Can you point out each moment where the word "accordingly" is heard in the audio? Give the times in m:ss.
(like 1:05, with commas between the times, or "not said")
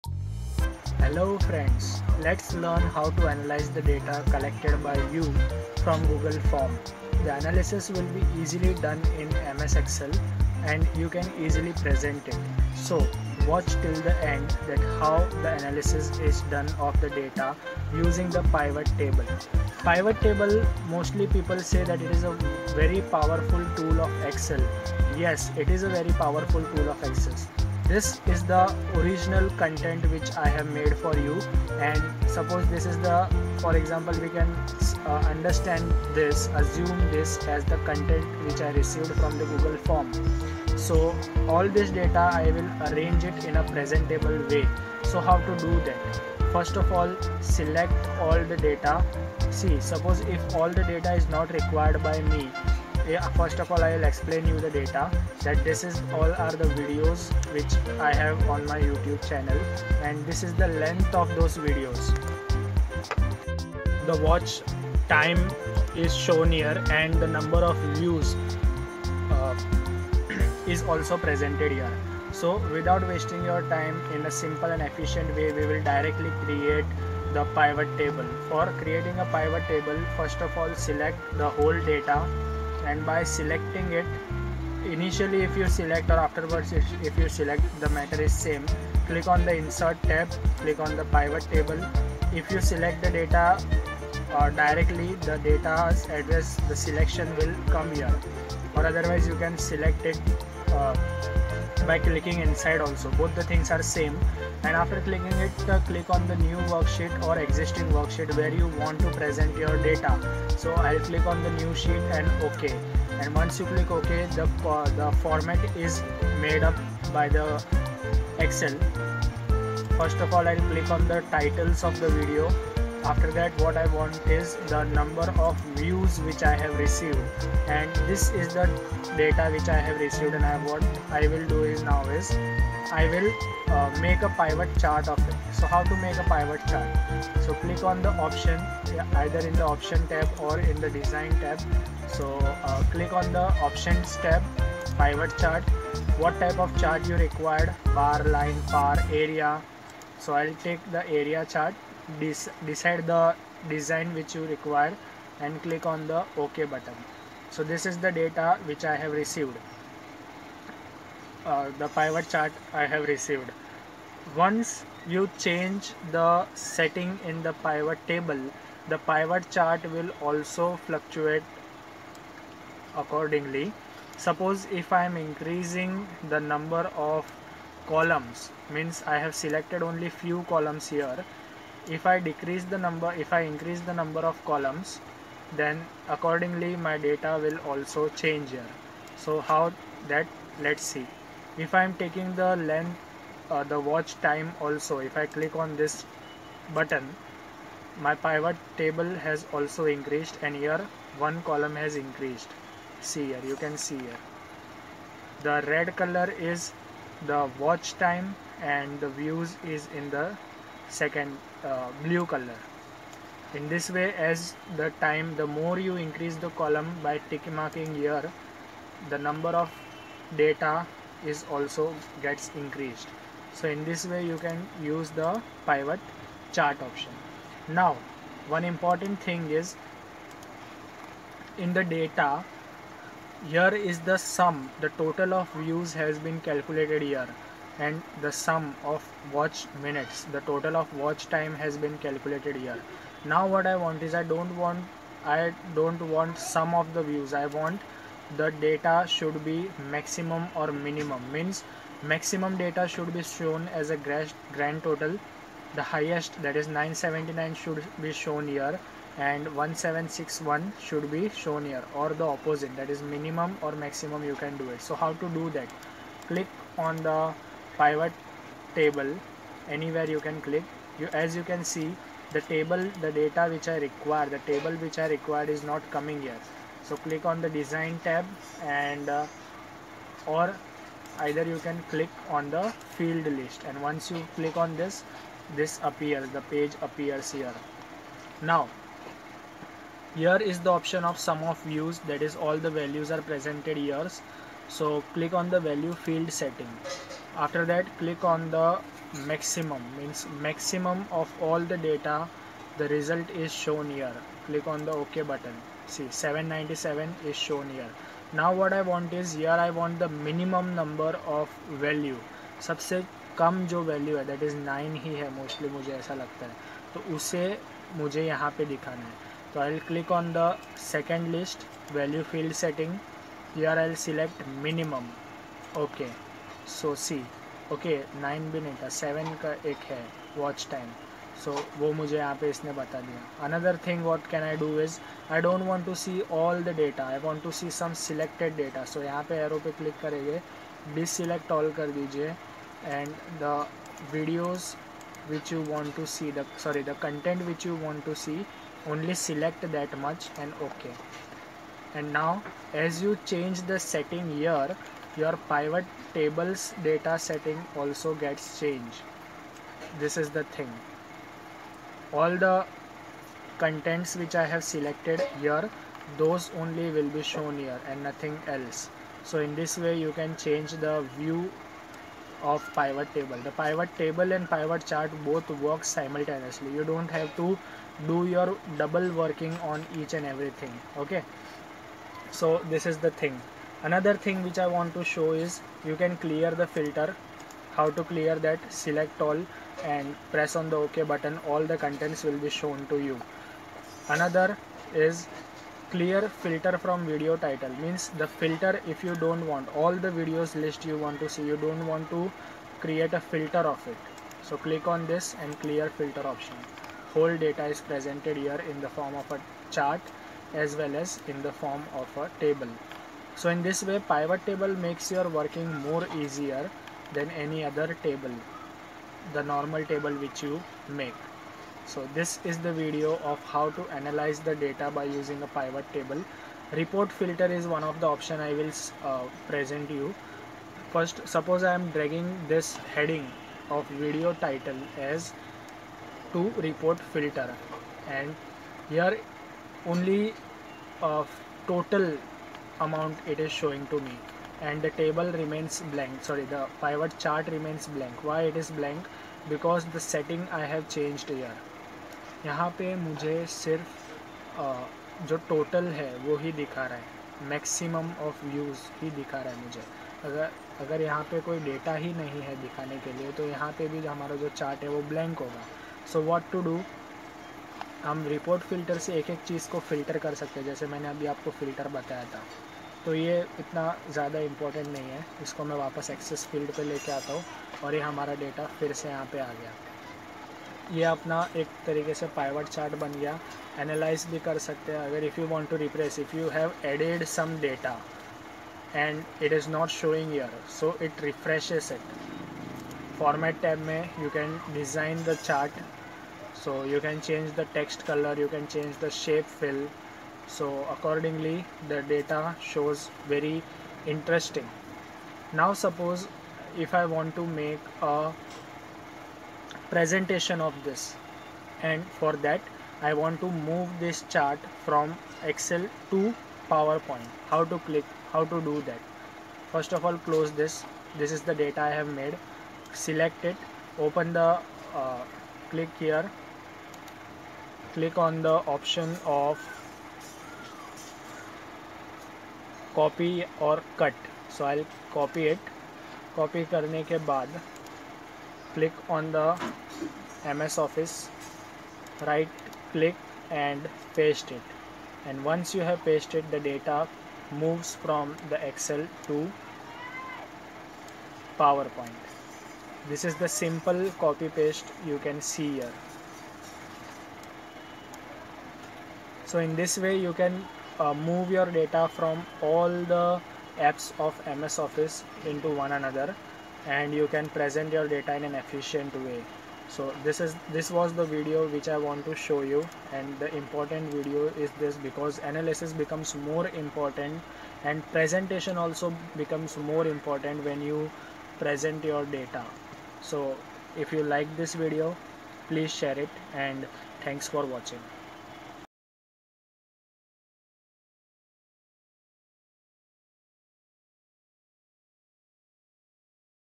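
2:52, 3:06, 8:20.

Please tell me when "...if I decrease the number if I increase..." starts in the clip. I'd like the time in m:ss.
3:01.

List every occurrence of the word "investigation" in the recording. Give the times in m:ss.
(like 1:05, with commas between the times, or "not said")
not said.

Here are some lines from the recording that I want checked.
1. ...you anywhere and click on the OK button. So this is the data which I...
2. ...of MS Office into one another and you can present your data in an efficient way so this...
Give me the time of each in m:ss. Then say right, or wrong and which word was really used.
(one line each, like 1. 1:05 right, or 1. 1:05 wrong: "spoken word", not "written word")
1. 2:34 wrong: "require", not "anywhere"
2. 9:24 right.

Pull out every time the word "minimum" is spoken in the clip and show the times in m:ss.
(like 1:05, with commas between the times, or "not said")
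4:10, 4:23, 5:10, 5:24.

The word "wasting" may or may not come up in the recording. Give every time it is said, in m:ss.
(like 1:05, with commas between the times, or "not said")
1:13.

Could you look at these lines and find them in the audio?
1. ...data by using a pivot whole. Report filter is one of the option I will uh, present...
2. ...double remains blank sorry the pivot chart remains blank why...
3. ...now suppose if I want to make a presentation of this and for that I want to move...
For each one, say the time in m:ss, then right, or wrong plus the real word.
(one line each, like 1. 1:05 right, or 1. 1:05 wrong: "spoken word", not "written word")
1. 7:04 wrong: "table", not "whole"
2. 7:24 wrong: "table", not "double"
3. 8:25 right.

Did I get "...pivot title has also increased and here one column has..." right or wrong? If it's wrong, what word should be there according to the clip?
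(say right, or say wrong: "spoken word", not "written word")
wrong: "table", not "title".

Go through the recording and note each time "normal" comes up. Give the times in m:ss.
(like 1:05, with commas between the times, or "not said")
6:59.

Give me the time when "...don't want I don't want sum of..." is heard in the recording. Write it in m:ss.
4:04.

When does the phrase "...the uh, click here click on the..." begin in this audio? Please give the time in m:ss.
8:44.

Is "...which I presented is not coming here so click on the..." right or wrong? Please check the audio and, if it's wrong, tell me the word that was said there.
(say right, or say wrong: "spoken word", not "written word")
wrong: "required", not "presented".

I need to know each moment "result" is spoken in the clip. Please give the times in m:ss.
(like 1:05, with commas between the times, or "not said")
5:02.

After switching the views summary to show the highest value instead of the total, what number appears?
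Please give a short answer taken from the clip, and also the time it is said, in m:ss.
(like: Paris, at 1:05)
797, at 5:06.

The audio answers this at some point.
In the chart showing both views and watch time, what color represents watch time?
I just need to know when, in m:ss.
3:25.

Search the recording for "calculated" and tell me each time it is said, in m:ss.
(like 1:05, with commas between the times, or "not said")
3:56, 4:02.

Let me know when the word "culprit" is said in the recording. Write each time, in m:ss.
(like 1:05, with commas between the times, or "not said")
not said.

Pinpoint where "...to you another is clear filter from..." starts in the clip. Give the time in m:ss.
6:32.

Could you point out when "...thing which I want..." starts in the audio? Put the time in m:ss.
6:24.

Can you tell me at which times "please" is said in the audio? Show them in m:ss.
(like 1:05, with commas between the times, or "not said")
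9:45.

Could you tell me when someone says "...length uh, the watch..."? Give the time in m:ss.
3:12.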